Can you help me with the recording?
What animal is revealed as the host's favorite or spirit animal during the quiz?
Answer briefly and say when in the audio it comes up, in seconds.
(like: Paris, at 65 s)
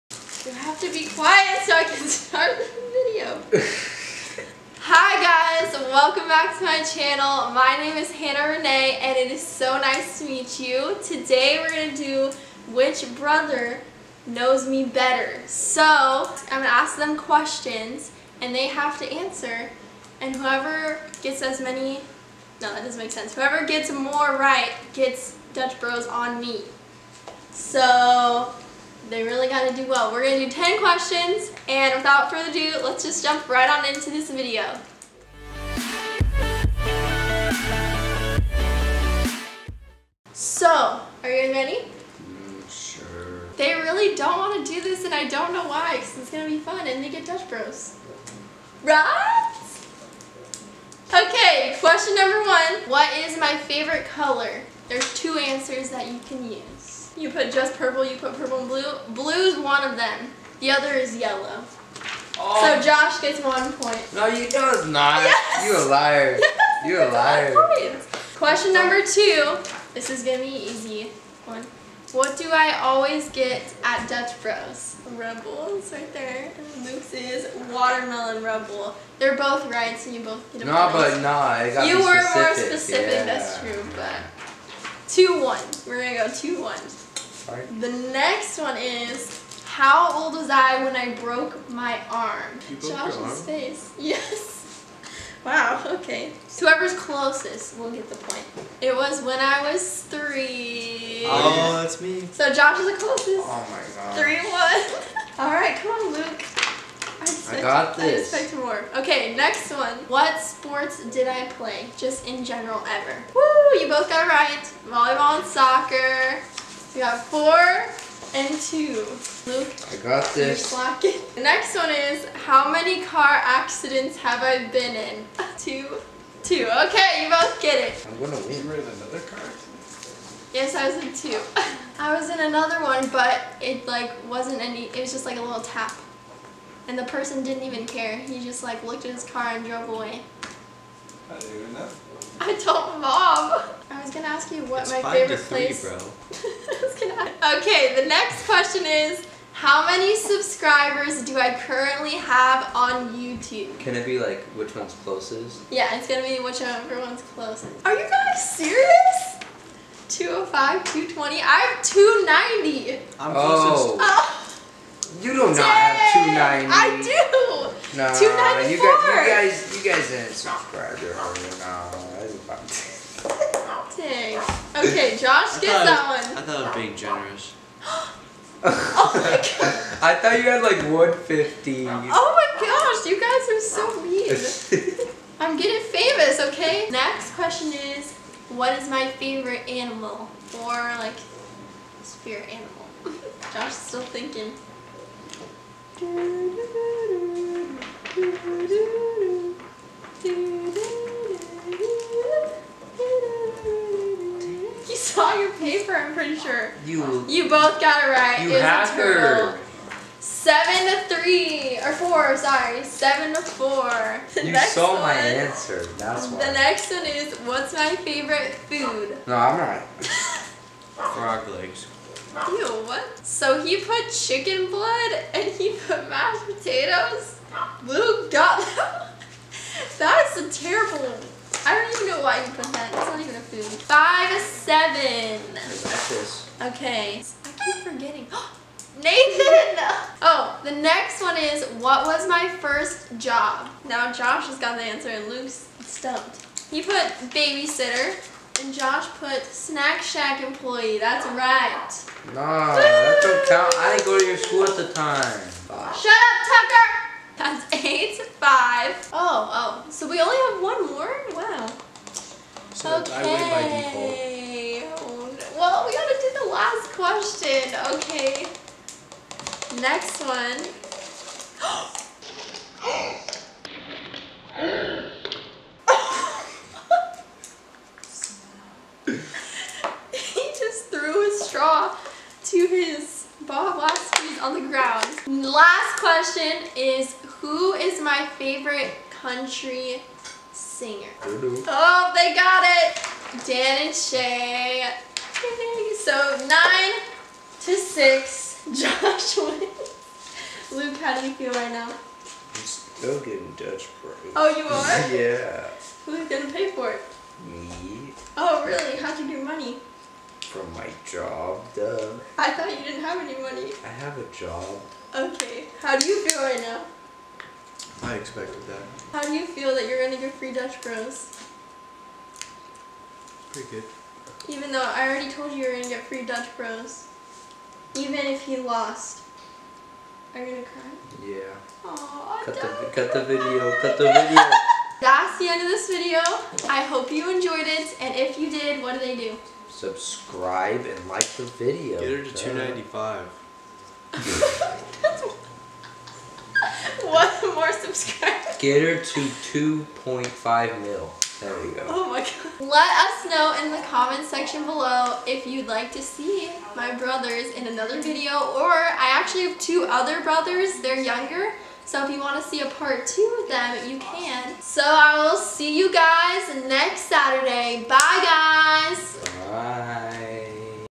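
Turtle, at 208 s.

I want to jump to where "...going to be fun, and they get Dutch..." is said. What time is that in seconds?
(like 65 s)
46 s.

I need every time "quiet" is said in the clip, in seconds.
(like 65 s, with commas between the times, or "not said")
1 s.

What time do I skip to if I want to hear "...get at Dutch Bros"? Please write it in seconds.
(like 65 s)
73 s.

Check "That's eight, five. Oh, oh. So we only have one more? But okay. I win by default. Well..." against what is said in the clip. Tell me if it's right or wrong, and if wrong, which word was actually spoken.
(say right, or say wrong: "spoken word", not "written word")
right.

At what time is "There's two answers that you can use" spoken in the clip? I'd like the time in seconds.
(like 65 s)
54 s.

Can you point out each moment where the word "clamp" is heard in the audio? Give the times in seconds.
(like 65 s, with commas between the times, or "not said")
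not said.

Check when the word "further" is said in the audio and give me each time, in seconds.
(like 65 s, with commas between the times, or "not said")
32 s.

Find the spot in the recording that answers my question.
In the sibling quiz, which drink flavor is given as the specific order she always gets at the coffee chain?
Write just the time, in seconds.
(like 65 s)
77 s.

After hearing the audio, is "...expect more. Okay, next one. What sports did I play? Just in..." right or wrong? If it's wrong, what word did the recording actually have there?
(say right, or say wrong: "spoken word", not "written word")
right.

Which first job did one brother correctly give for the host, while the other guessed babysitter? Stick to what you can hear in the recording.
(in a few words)
Snack shack employee.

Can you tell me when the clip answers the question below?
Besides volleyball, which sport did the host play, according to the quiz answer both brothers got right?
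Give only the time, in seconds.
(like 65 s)
115 s.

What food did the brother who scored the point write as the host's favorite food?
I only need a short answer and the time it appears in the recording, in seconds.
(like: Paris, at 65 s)
Mashed potatoes, at 226 s.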